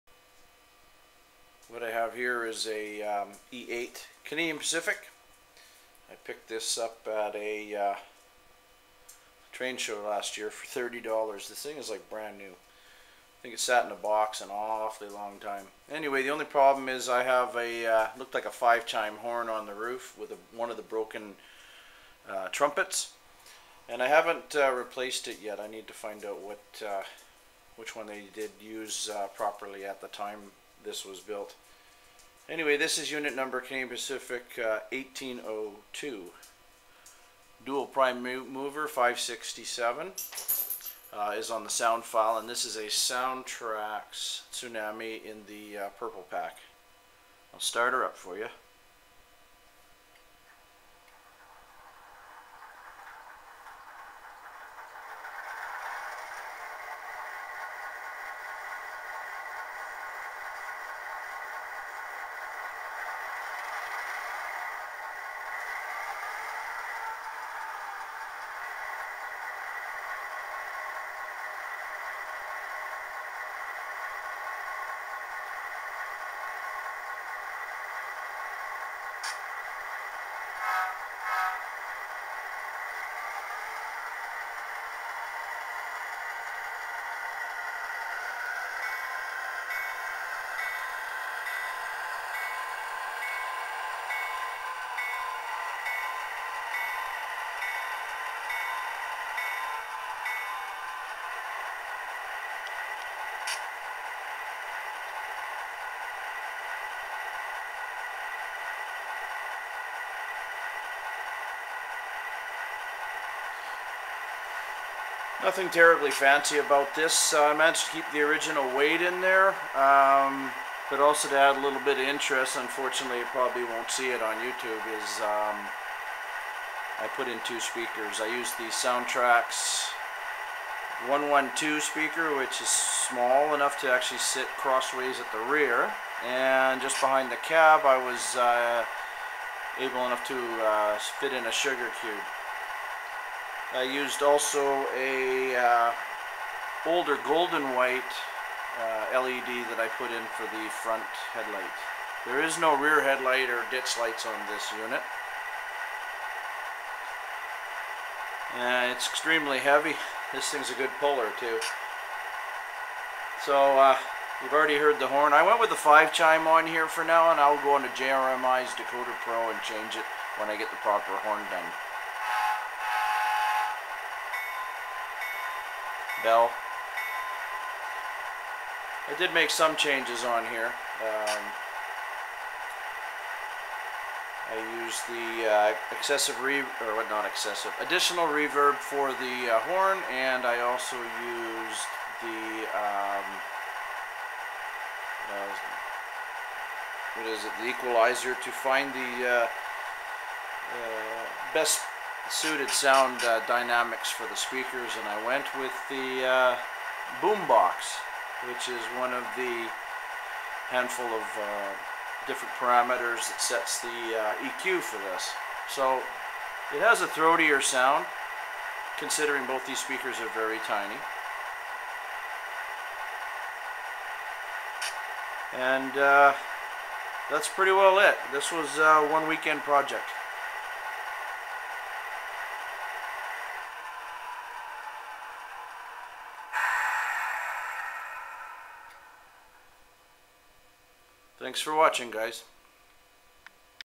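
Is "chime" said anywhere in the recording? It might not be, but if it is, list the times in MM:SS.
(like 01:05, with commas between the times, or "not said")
00:18, 02:46.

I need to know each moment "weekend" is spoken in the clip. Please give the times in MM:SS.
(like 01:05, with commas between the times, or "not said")
03:49.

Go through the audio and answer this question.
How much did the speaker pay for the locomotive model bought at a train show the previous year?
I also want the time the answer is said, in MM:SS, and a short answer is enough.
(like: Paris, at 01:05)
$30, at 00:10.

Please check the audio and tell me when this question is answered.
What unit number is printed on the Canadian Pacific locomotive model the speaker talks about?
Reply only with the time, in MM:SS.
00:34.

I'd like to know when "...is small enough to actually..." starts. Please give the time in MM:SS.
02:12.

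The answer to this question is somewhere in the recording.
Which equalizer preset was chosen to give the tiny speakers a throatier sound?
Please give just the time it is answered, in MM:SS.
03:27.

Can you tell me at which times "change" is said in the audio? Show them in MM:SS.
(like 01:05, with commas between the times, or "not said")
02:49, 02:59.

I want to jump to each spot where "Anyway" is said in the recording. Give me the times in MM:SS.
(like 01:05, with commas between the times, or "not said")
00:15, 00:32.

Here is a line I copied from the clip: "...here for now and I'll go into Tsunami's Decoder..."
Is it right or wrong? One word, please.
wrong.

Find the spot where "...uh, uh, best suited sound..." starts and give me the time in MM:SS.
03:19.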